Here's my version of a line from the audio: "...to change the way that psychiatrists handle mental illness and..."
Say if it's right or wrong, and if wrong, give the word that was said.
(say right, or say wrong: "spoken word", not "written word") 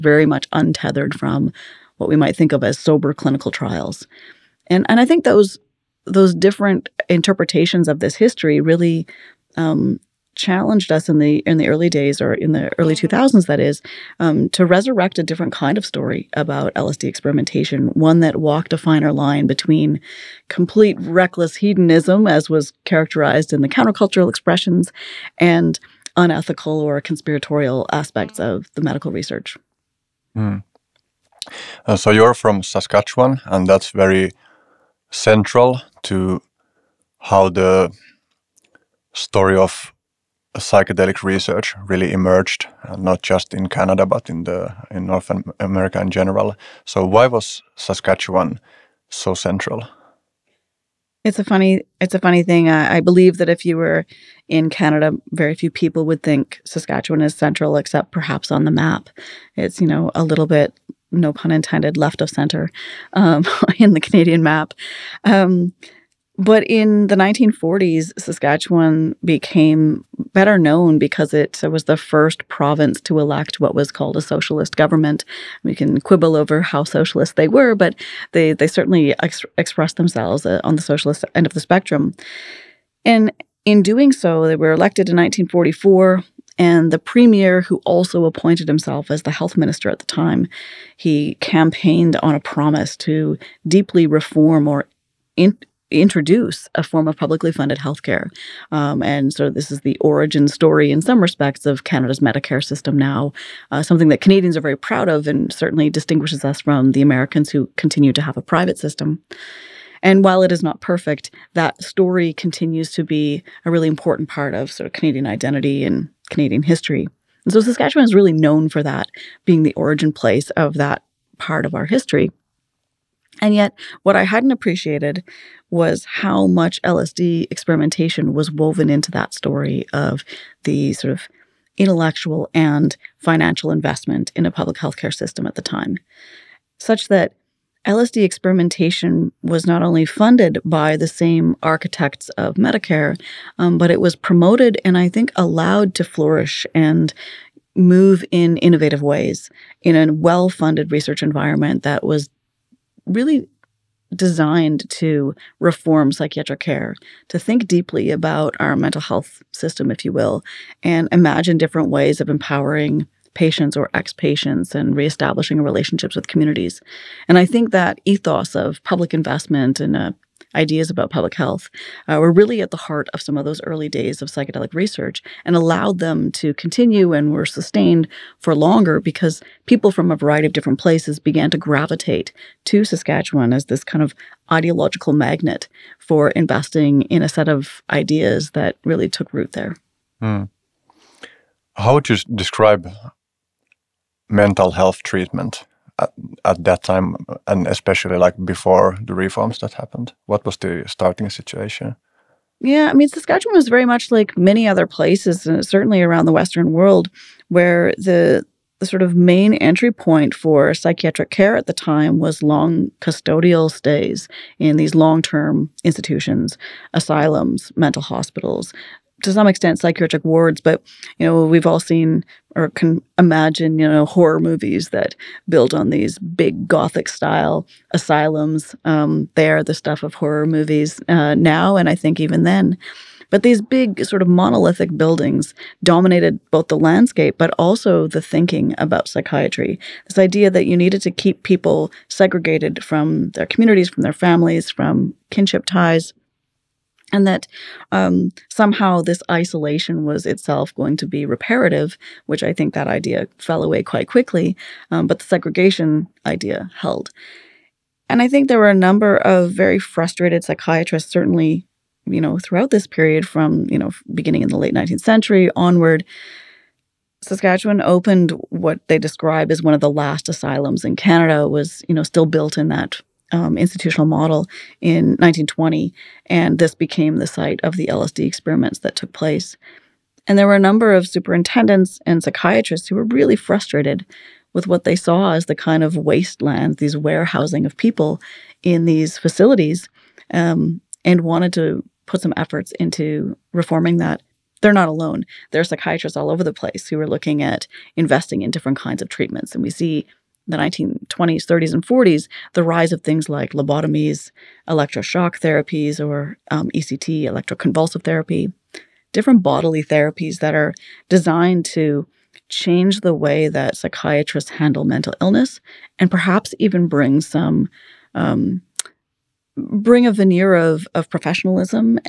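right.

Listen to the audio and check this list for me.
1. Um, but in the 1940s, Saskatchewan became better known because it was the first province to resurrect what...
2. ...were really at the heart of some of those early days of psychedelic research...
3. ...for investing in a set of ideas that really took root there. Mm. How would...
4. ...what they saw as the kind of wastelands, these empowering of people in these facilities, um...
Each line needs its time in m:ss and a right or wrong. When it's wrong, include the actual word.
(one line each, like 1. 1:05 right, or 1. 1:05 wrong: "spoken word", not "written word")
1. 1:05 wrong: "elect", not "resurrect"
2. 2:52 right
3. 3:05 right
4. 4:44 wrong: "warehousing", not "empowering".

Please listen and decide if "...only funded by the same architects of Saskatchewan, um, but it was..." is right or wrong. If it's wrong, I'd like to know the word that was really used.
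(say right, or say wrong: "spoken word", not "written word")
wrong: "Medicare", not "Saskatchewan".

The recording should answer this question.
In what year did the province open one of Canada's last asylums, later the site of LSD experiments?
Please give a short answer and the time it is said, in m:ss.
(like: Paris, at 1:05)
1920, at 4:35.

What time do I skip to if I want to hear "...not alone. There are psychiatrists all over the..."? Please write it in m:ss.
4:54.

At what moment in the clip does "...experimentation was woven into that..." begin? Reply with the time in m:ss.
2:07.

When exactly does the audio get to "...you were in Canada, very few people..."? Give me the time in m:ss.
0:53.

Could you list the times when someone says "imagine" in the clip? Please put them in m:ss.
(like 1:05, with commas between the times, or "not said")
2:41, 3:43.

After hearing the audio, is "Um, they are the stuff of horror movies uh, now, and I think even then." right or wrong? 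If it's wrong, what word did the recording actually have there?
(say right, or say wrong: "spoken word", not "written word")
right.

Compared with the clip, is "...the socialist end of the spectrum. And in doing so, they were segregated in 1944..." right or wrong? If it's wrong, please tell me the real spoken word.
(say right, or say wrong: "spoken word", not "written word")
wrong: "elected", not "segregated".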